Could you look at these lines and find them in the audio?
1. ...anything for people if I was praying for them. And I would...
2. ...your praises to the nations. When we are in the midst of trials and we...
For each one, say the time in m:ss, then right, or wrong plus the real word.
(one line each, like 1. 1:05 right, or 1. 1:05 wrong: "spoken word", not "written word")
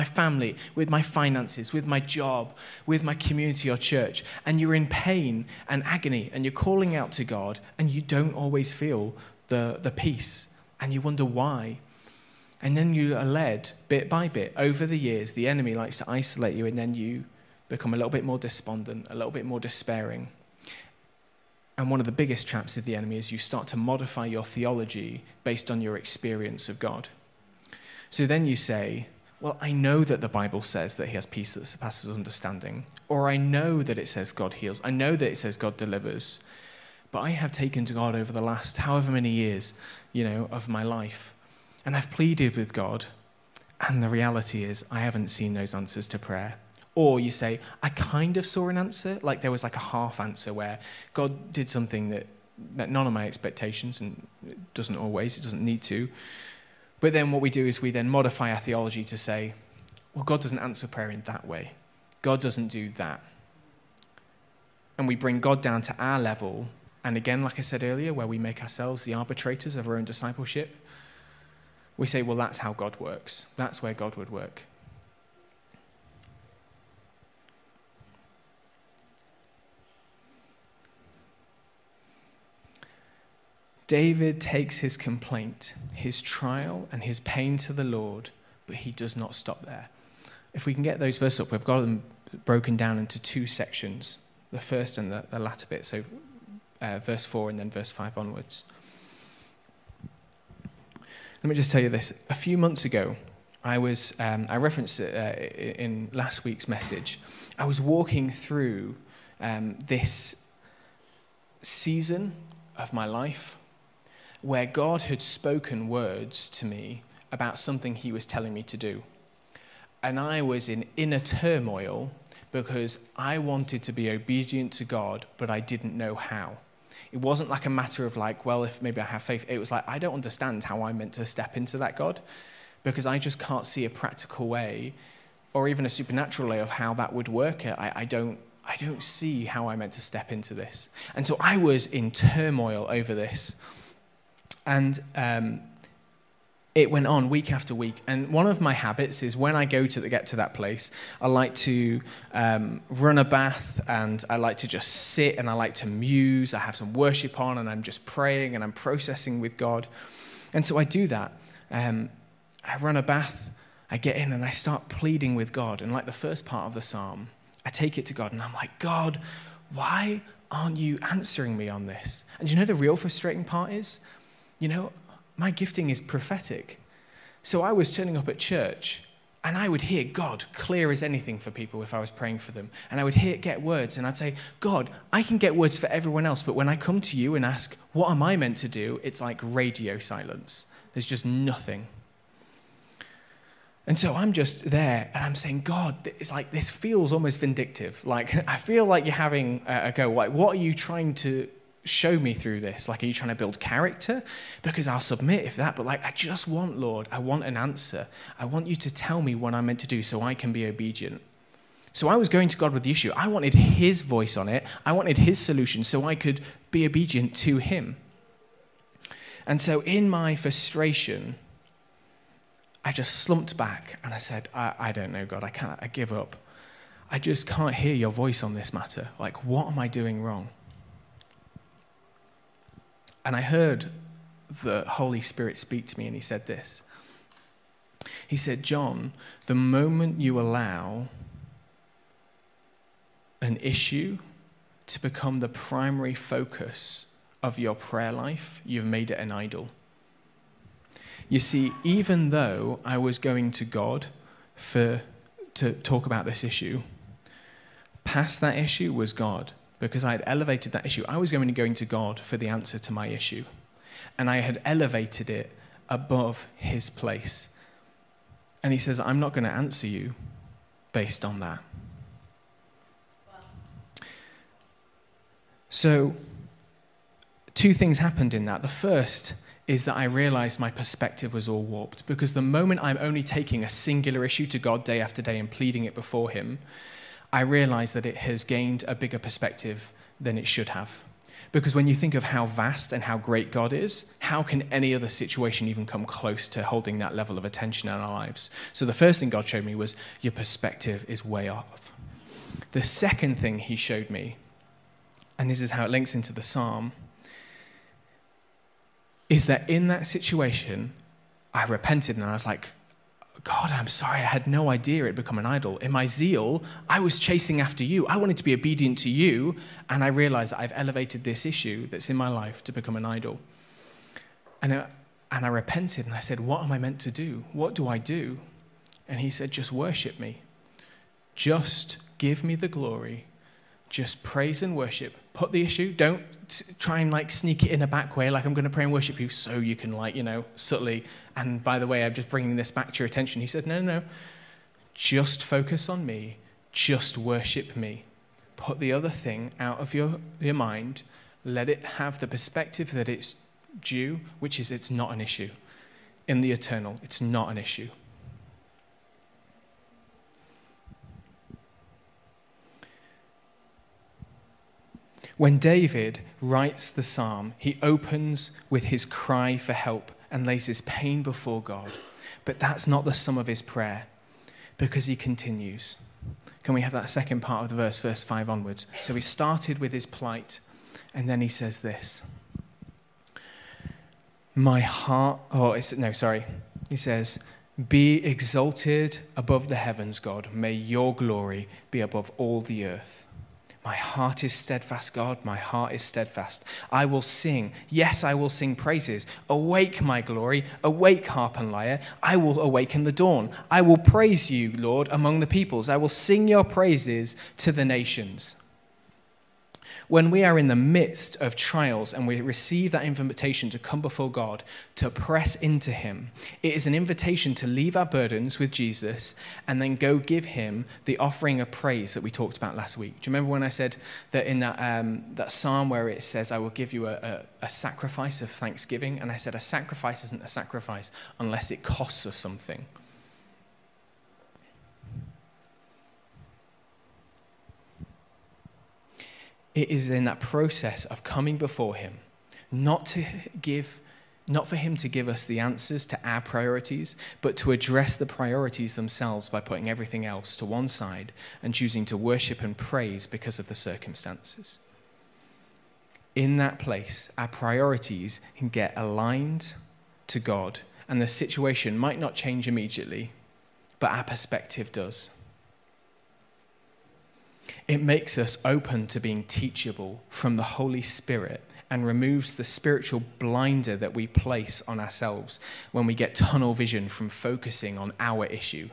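1. 3:01 right
2. 6:46 right.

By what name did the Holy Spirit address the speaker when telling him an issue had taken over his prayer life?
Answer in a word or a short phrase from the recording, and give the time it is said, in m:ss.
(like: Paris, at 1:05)
John, at 3:58.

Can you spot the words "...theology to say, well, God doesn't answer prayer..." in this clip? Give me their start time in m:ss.
0:58.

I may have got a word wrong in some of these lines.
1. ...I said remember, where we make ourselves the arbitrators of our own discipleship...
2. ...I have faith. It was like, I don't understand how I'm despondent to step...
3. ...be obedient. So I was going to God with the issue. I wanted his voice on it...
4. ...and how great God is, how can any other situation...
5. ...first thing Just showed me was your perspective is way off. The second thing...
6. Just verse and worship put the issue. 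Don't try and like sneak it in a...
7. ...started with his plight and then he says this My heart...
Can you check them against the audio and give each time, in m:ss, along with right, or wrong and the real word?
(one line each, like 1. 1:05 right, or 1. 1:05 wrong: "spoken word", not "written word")
1. 1:07 wrong: "earlier", not "remember"
2. 2:08 wrong: "meant", not "despondent"
3. 3:30 right
4. 4:52 right
5. 4:58 wrong: "God", not "Just"
6. 5:33 wrong: "praise", not "verse"
7. 6:19 right.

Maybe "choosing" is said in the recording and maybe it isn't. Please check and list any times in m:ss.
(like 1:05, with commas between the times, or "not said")
7:31.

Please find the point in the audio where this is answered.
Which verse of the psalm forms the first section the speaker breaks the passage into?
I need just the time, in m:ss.
1:36.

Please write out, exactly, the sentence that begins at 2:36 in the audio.
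I have some worship on and I'm just praying and I'm processing with God.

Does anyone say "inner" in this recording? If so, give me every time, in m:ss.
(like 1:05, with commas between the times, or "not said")
2:00.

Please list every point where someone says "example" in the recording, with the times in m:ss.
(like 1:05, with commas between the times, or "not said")
not said.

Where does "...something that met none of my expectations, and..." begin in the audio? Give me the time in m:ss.
0:51.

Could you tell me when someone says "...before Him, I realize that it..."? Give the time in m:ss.
4:45.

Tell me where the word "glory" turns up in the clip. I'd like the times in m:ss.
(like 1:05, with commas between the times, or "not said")
5:32, 6:31, 6:40.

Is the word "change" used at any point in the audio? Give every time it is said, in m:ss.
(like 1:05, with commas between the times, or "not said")
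7:42.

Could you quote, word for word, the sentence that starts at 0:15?
The enemy likes to isolate you and then you become a little bit more despondent, a little bit more despairing.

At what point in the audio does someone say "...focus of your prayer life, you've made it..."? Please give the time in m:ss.
4:06.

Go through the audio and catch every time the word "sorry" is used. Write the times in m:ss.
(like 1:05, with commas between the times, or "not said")
5:13, 6:26.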